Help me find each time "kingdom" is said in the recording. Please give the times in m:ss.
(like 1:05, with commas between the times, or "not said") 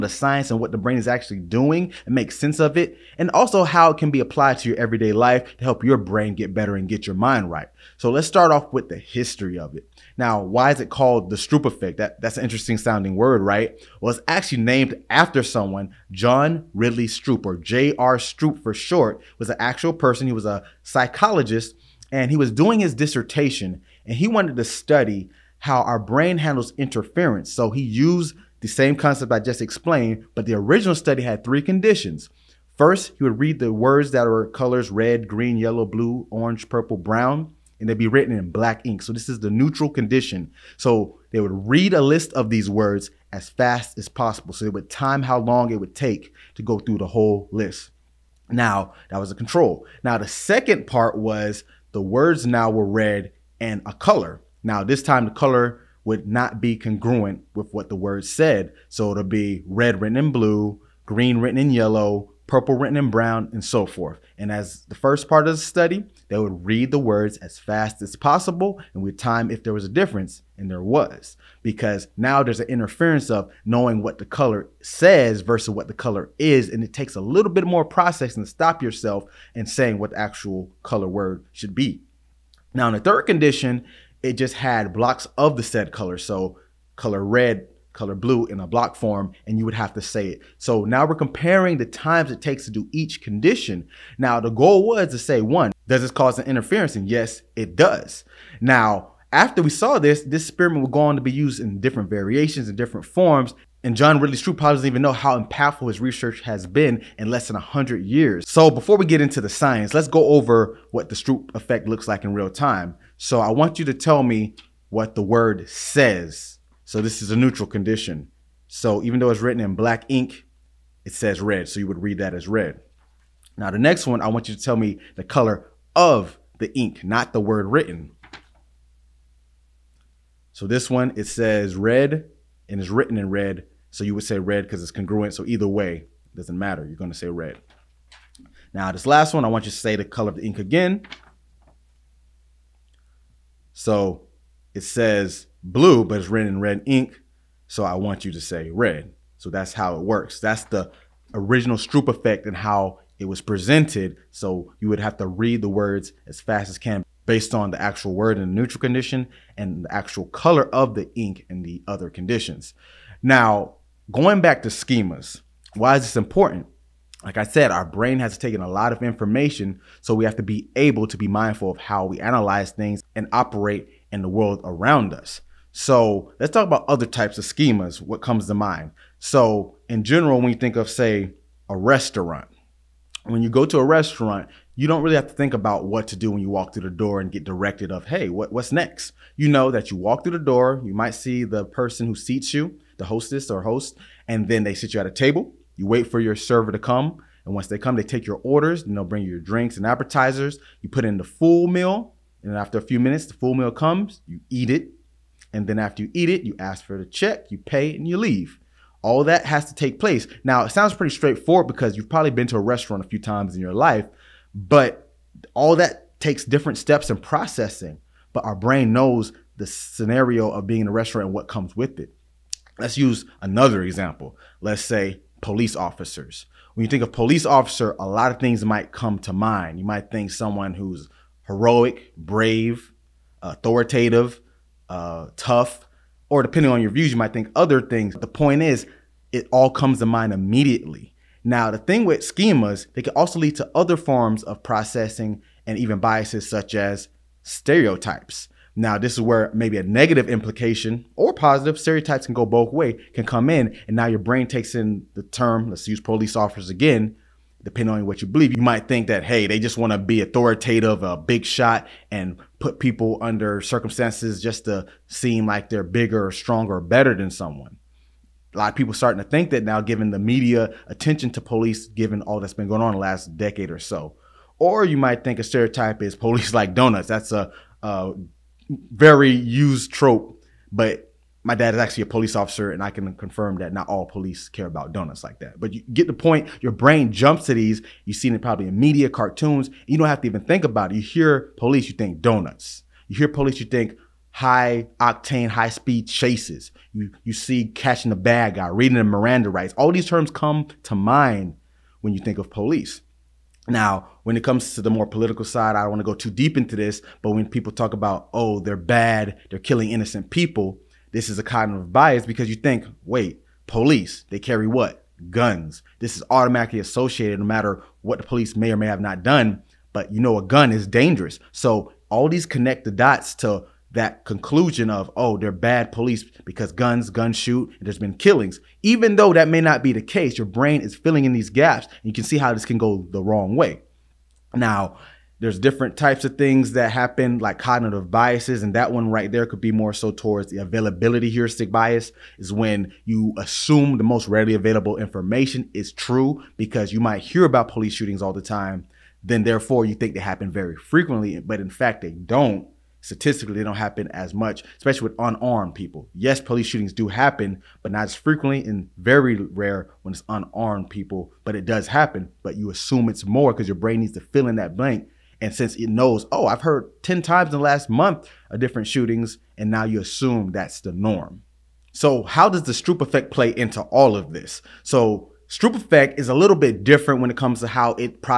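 not said.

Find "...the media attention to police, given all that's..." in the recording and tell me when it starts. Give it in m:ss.
4:30.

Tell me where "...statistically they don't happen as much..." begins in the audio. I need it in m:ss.
5:53.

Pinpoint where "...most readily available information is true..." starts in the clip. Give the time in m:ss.
5:44.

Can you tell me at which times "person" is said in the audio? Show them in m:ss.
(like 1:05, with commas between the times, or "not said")
0:19, 3:11.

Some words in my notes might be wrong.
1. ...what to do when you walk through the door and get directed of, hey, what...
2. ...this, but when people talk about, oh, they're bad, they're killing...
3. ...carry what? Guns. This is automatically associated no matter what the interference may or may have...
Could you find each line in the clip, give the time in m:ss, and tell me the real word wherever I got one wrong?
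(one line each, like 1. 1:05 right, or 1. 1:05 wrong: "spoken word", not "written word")
1. 3:05 right
2. 5:06 right
3. 5:14 wrong: "police", not "interference".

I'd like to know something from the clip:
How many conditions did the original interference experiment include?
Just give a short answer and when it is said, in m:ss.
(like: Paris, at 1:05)
3, at 0:31.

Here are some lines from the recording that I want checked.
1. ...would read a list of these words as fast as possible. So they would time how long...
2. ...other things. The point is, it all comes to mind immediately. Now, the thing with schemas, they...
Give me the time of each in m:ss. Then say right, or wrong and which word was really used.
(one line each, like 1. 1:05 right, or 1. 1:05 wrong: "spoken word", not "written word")
1. 0:41 right
2. 3:57 right.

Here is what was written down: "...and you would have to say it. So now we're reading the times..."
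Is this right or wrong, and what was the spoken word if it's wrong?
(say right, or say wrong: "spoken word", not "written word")
wrong: "comparing", not "reading".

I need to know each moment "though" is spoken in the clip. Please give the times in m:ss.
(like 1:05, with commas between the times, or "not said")
1:59, 5:29.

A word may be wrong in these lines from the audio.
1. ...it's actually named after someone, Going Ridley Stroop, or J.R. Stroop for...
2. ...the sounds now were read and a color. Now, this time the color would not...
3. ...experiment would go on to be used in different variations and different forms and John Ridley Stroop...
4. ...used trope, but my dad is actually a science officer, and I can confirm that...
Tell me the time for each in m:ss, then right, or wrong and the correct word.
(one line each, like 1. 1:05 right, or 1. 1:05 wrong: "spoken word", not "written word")
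1. 0:14 wrong: "John", not "Going"
2. 0:51 wrong: "words", not "sounds"
3. 1:40 right
4. 4:39 wrong: "police", not "science".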